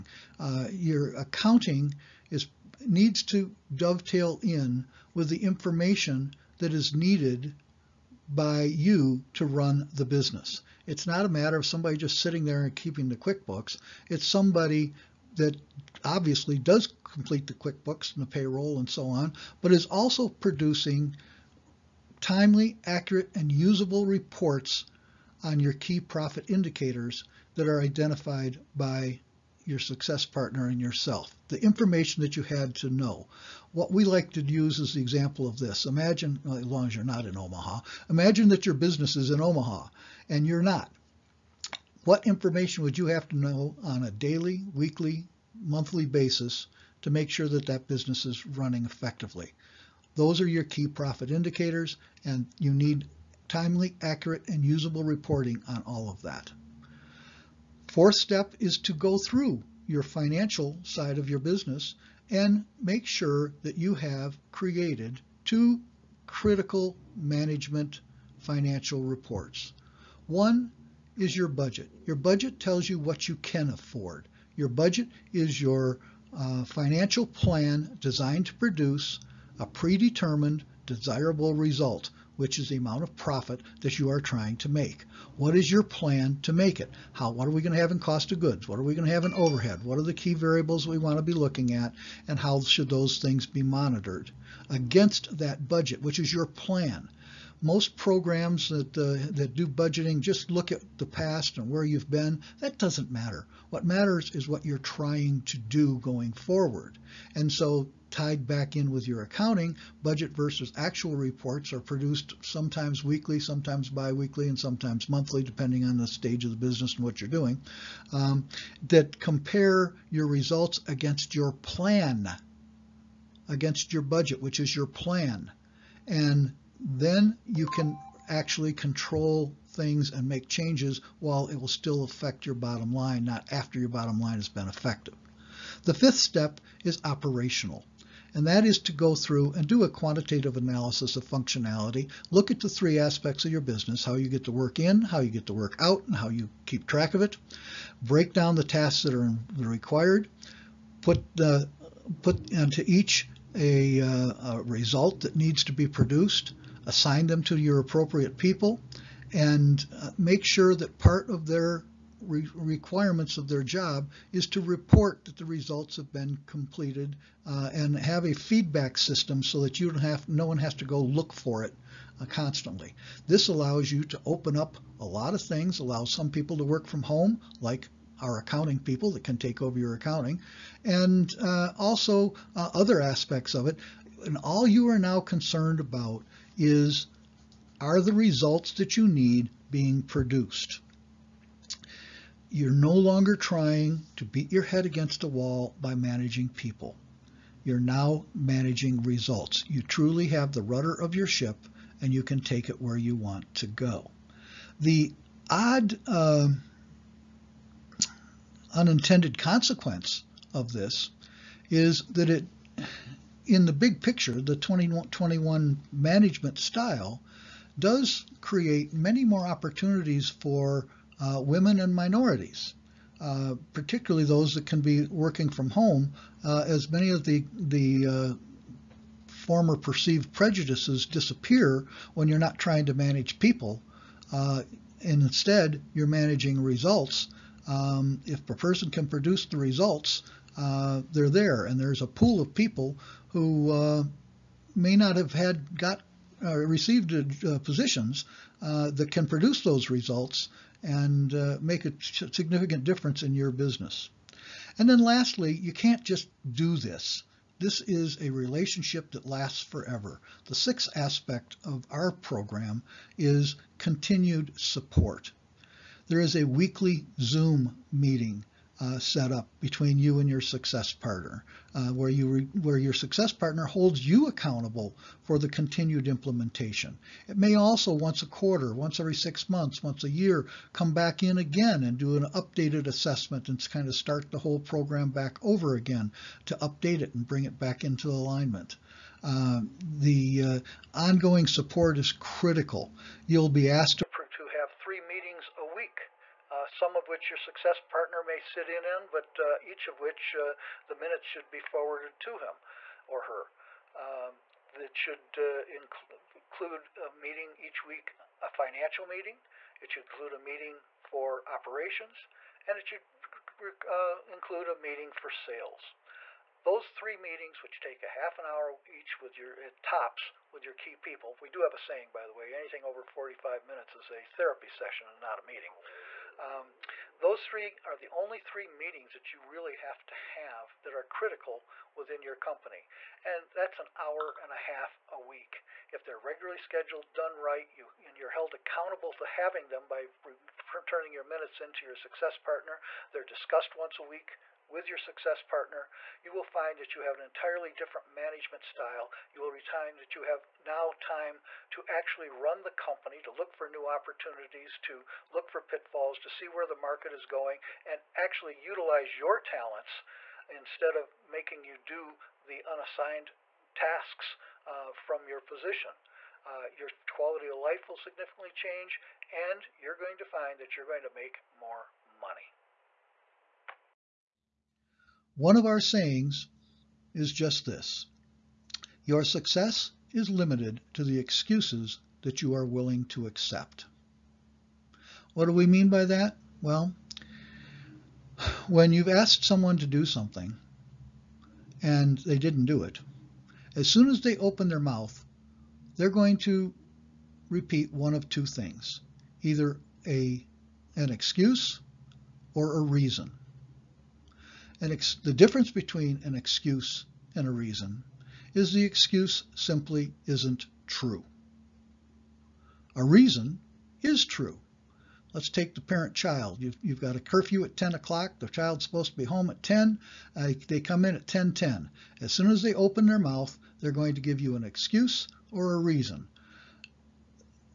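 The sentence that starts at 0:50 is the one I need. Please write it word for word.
Those are your key profit indicators, and you need timely, accurate, and usable reporting on all of that.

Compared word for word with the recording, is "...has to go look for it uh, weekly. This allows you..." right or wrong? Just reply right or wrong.
wrong.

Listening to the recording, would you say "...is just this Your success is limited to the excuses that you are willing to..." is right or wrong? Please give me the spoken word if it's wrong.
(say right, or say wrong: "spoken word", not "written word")
right.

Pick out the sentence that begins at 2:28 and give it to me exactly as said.
Break down the tasks that are required.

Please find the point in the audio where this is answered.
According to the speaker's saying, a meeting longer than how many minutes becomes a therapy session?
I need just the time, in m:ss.
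5:23.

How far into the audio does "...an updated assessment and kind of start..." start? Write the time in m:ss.
4:42.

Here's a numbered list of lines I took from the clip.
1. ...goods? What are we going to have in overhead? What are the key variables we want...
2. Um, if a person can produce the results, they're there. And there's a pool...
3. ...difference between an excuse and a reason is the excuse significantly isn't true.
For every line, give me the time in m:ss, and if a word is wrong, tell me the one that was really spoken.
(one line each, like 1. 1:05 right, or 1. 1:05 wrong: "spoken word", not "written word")
1. 1:28 right
2. 3:57 right
3. 6:45 wrong: "simply", not "significantly".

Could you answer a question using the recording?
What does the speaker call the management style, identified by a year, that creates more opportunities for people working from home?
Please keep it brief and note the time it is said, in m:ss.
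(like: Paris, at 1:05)
2021 management style, at 3:34.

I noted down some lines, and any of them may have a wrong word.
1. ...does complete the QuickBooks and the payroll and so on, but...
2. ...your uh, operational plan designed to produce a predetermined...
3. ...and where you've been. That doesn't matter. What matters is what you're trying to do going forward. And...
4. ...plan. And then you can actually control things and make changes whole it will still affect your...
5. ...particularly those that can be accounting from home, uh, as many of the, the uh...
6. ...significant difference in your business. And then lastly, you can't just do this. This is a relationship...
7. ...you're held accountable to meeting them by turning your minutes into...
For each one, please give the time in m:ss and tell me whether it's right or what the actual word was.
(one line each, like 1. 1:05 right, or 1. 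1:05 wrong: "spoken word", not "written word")
1. 0:16 right
2. 1:15 wrong: "financial", not "operational"
3. 1:41 right
4. 2:04 wrong: "while", not "whole"
5. 3:43 wrong: "working", not "accounting"
6. 4:12 right
7. 5:38 wrong: "having", not "meeting".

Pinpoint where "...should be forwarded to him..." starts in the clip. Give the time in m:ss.
5:01.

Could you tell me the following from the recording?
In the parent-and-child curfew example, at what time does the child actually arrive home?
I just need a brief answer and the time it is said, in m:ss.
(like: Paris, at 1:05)
10:10, at 7:01.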